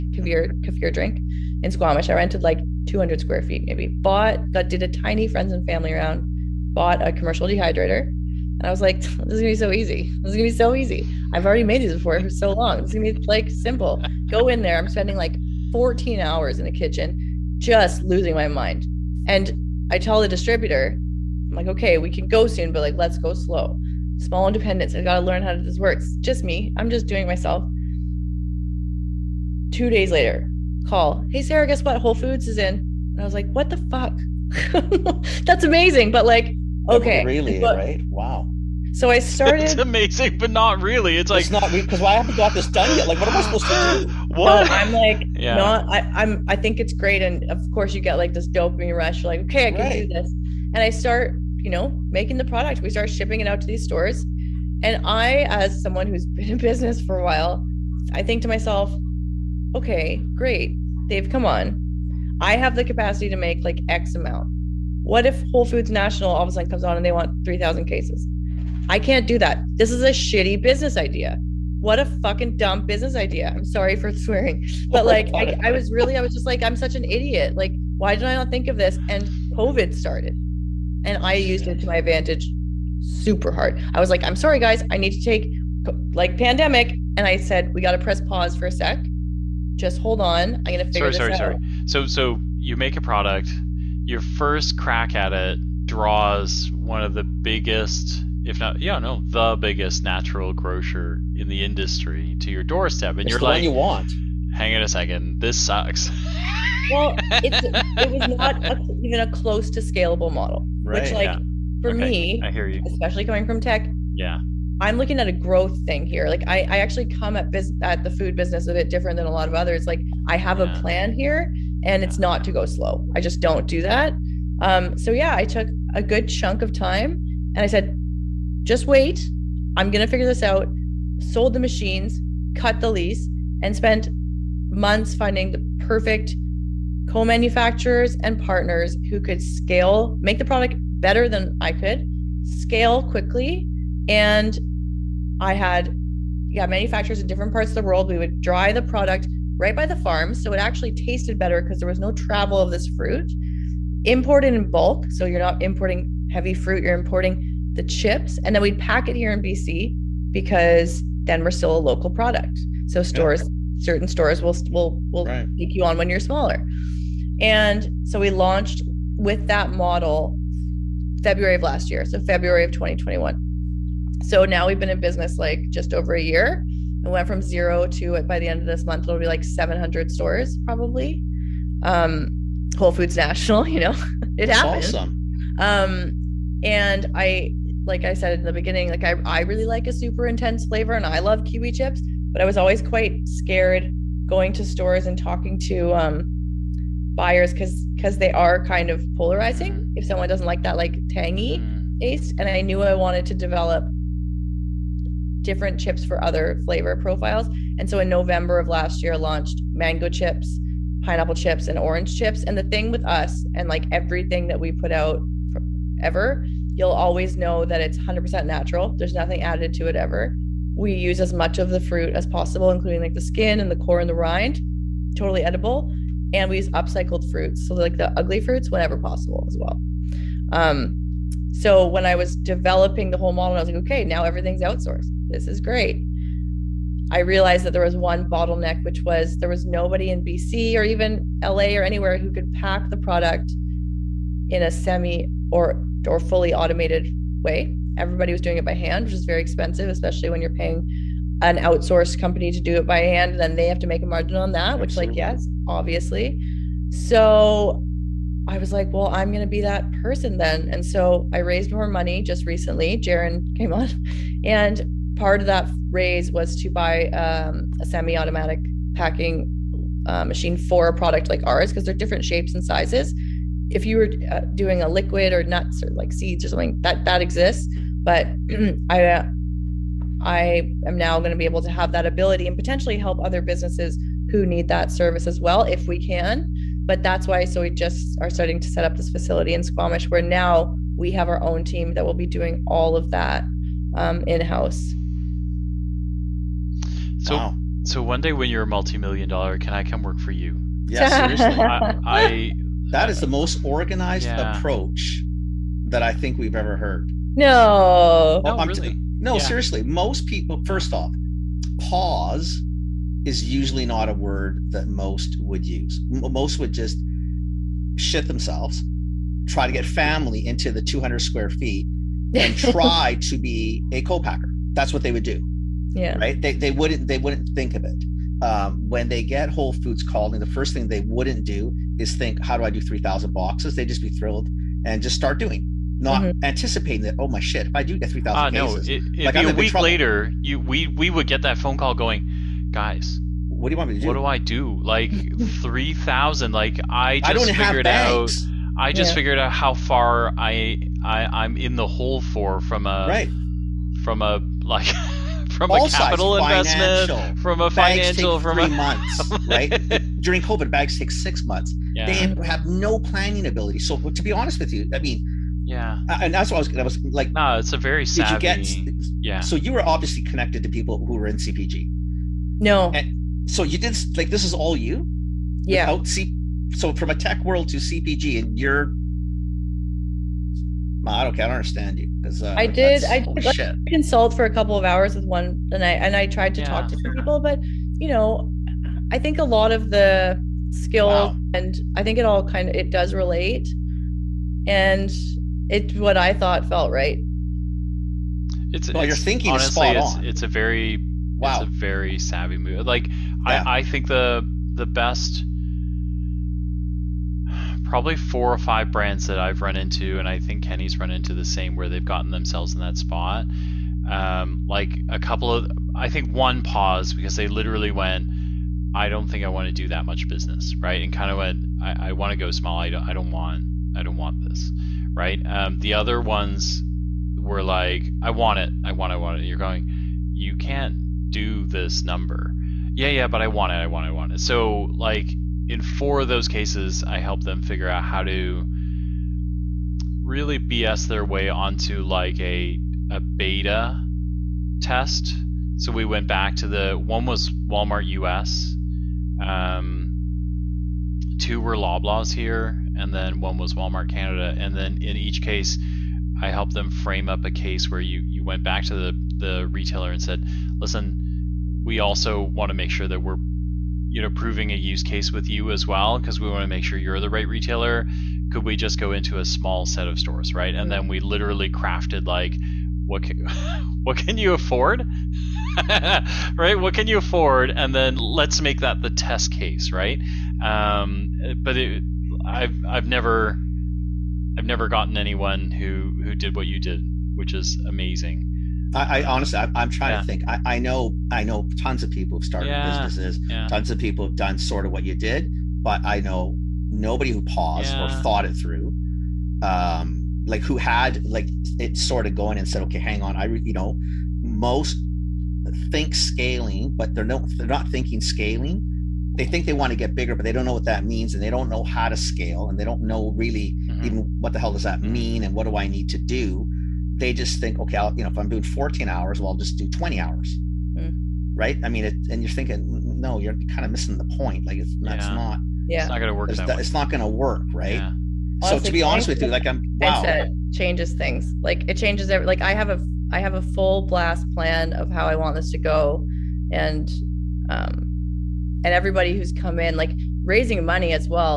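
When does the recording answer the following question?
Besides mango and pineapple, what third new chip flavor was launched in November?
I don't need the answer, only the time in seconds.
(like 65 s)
211 s.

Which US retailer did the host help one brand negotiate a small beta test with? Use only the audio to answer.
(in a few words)
Walmart US.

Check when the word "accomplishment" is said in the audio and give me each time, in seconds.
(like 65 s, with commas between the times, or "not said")
not said.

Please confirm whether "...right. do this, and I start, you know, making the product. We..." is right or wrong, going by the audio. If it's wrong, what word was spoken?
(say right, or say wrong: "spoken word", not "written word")
right.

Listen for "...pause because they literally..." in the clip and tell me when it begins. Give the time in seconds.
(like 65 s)
416 s.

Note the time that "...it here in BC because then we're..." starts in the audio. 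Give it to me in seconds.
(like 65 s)
159 s.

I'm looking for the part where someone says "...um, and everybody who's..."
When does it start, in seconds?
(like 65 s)
537 s.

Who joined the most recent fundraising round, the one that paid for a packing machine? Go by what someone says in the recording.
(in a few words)
Jaron.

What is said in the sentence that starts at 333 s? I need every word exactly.
They'd just be thrilled and just start doing, not mm-hmm.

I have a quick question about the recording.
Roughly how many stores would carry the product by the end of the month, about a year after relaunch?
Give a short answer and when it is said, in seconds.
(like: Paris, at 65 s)
700, at 179 s.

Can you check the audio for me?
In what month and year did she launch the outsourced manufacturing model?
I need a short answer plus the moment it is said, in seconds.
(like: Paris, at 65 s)
February 2021, at 172 s.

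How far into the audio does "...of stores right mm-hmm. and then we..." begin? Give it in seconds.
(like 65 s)
470 s.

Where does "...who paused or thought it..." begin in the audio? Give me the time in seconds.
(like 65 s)
497 s.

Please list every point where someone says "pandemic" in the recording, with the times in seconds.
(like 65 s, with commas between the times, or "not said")
86 s.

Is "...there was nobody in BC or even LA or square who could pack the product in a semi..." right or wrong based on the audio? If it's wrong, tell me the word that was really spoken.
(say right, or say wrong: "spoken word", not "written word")
wrong: "anywhere", not "square".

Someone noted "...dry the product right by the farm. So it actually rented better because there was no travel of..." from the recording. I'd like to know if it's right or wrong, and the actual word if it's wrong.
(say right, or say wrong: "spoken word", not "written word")
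wrong: "tasted", not "rented".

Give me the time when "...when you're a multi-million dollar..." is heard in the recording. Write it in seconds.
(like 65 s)
298 s.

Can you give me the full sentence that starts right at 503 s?
I, you know, most think scaling, but they're no, they're not thinking scaling.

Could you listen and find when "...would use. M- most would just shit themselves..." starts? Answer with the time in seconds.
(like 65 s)
315 s.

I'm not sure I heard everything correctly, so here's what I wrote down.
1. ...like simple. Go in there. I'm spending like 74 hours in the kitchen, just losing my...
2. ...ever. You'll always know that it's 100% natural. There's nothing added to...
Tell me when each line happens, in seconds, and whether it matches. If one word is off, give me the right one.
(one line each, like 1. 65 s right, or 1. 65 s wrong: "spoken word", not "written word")
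1. 13 s wrong: "14", not "74"
2. 215 s right.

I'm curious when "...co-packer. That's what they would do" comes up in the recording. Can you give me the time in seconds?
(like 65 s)
324 s.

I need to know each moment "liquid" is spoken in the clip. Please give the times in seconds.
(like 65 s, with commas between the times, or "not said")
274 s.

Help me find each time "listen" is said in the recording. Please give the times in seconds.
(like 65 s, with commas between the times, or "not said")
460 s.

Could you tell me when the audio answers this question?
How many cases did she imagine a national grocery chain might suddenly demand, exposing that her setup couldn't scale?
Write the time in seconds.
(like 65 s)
67 s.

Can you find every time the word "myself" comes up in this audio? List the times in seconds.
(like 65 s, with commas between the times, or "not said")
27 s, 58 s.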